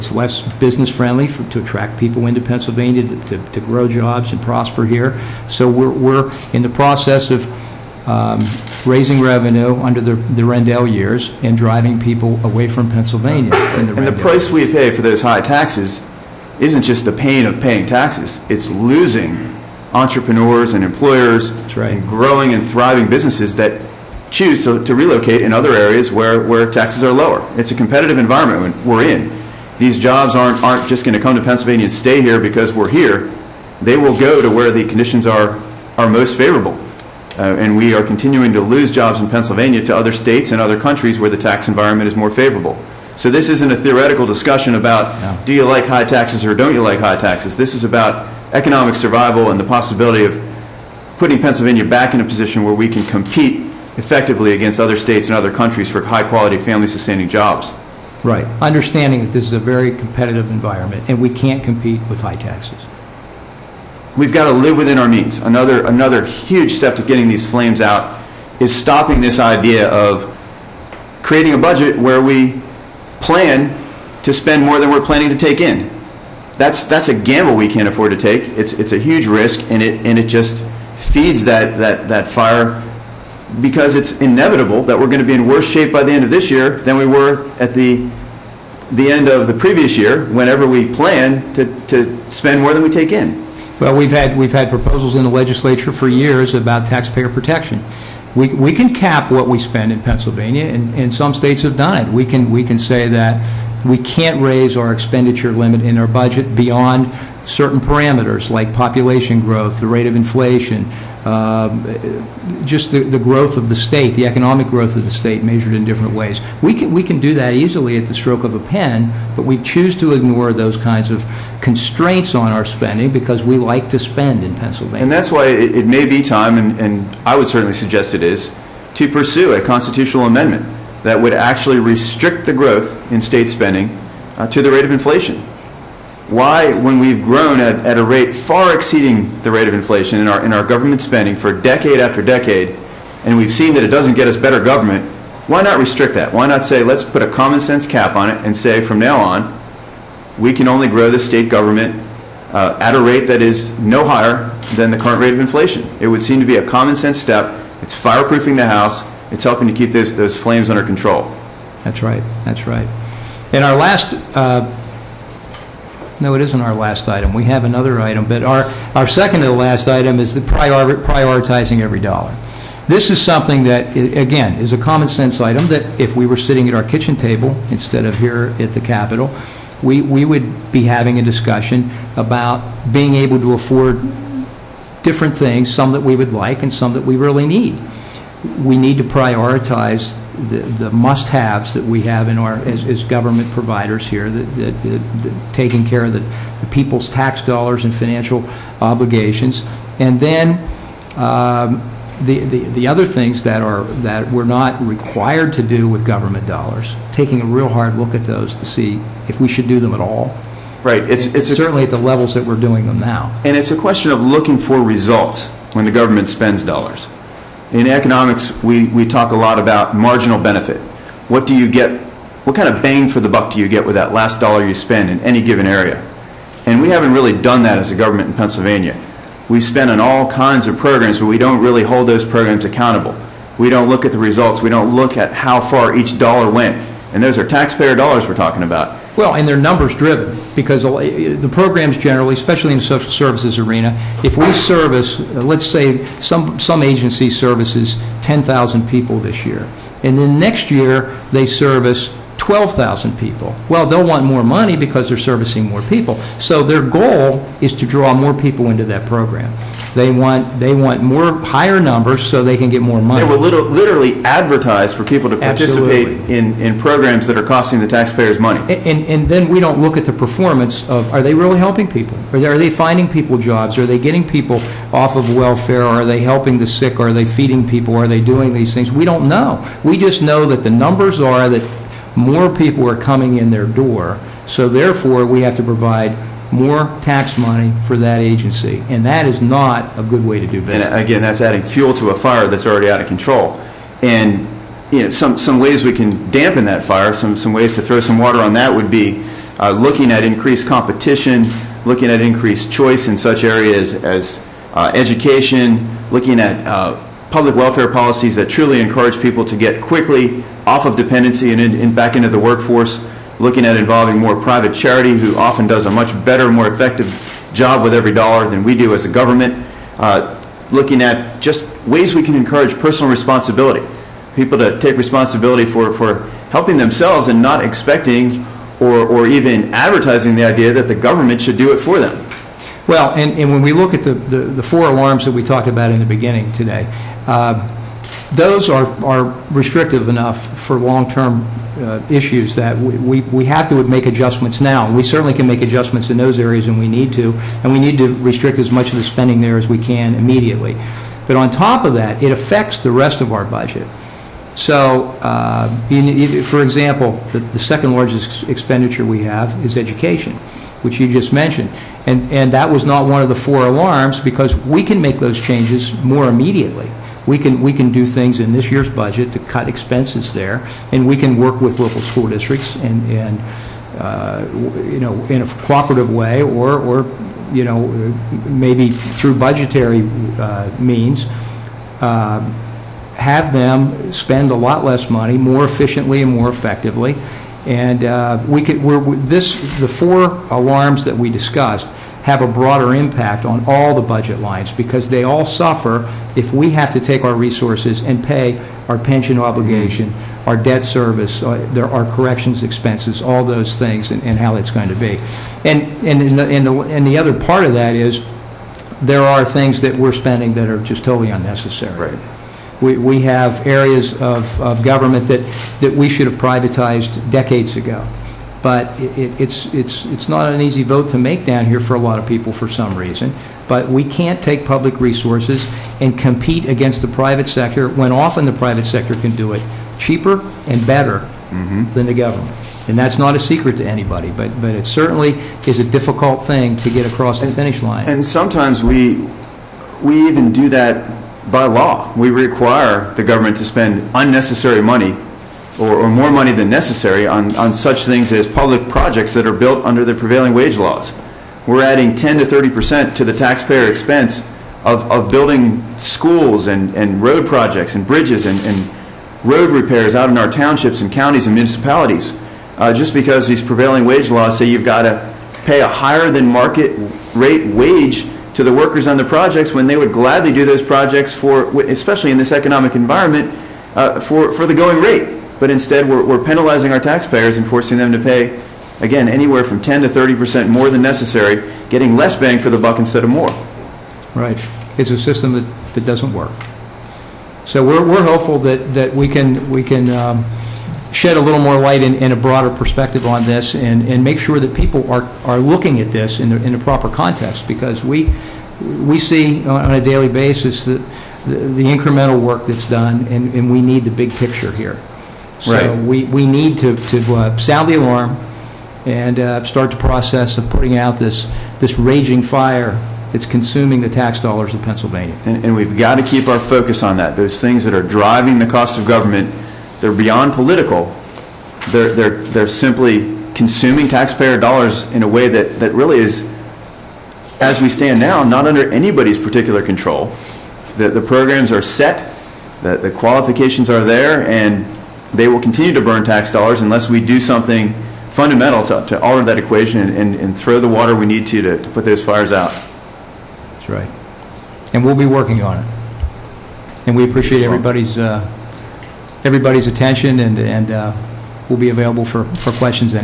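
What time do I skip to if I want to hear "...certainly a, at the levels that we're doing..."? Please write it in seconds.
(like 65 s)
211 s.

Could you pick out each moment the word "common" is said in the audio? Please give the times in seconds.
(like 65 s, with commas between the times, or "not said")
147 s, 156 s, 174 s.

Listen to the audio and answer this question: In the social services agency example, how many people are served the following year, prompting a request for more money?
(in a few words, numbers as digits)
12,000.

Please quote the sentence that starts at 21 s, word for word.
and growing and thriving businesses that choose to, to relocate in other areas where, where taxes are lower.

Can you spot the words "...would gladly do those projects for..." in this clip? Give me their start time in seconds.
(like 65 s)
469 s.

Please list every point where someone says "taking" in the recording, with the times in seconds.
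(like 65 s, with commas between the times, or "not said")
195 s, 207 s.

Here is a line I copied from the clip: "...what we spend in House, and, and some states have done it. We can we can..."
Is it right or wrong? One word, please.
wrong.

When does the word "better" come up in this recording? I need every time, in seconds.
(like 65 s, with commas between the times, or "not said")
144 s, 316 s, 430 s.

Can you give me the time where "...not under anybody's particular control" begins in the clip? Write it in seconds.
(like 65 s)
528 s.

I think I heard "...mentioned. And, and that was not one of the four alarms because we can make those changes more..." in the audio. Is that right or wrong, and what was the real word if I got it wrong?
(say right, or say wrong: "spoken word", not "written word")
right.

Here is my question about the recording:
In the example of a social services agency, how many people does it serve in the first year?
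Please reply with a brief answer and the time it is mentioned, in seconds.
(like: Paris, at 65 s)
10,000, at 248 s.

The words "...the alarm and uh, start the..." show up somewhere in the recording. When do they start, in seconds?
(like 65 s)
507 s.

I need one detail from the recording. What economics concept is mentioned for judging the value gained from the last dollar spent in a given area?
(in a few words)
marginal benefit.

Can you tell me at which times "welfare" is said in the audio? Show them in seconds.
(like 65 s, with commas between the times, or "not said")
275 s, 307 s.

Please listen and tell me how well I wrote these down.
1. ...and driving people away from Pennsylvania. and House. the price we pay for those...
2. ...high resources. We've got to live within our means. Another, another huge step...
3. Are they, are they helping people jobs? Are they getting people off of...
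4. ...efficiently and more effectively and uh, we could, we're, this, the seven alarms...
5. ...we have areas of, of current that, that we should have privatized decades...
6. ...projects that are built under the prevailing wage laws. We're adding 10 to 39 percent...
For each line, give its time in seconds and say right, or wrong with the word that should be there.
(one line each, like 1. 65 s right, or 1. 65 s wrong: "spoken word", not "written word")
1. 11 s wrong: "Rendell", not "House"
2. 62 s wrong: "taxes", not "resources"
3. 272 s wrong: "finding", not "helping"
4. 385 s wrong: "four", not "seven"
5. 412 s wrong: "government", not "current"
6. 448 s wrong: "30", not "39".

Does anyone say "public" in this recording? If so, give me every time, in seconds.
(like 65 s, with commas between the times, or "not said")
307 s, 424 s, 448 s.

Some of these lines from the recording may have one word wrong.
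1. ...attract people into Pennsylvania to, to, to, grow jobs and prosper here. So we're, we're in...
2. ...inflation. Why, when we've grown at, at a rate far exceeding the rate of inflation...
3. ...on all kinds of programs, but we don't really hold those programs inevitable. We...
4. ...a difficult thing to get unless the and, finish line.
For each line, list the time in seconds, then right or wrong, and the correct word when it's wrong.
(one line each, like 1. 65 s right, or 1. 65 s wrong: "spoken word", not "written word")
1. 1 s right
2. 134 s right
3. 229 s wrong: "accountable", not "inevitable"
4. 435 s wrong: "across", not "unless".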